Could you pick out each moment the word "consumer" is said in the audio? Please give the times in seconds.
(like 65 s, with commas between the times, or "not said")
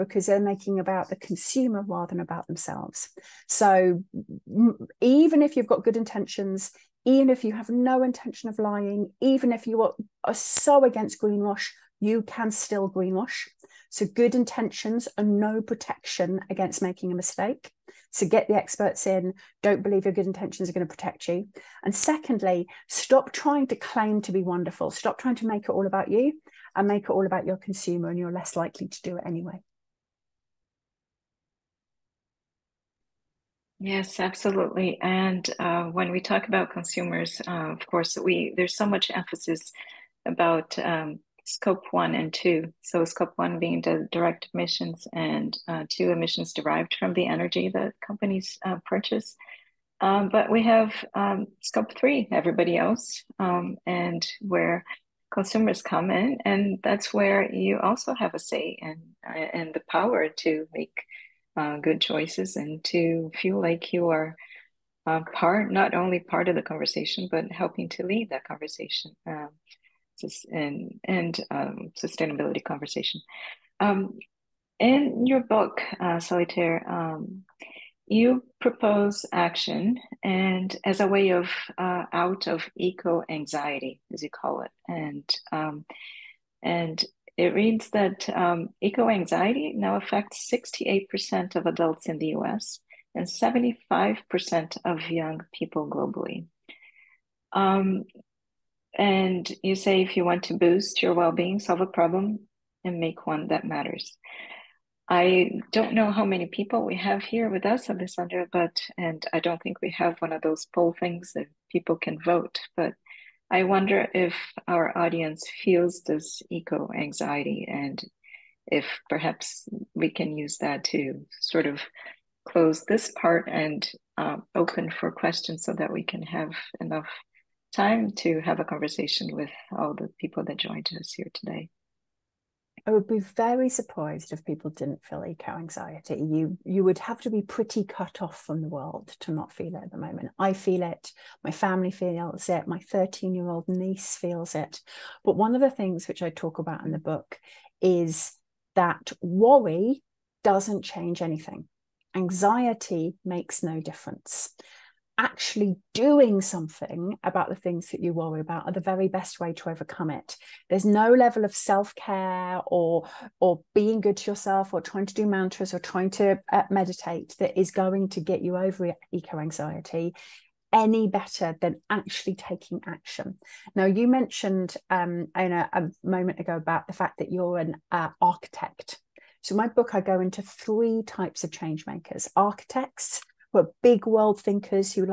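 1 s, 27 s, 36 s, 55 s.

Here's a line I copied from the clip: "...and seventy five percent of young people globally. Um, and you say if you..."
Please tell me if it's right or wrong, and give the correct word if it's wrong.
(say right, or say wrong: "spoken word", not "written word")
right.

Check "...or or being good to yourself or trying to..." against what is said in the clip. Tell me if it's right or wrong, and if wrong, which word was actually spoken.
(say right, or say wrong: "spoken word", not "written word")
right.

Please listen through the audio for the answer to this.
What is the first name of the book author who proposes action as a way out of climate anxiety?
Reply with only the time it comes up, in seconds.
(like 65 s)
76 s.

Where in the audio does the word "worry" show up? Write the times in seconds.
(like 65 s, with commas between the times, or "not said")
149 s, 158 s.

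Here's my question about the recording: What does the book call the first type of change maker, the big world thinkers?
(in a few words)
architects.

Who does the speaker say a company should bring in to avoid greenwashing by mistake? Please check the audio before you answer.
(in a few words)
the experts.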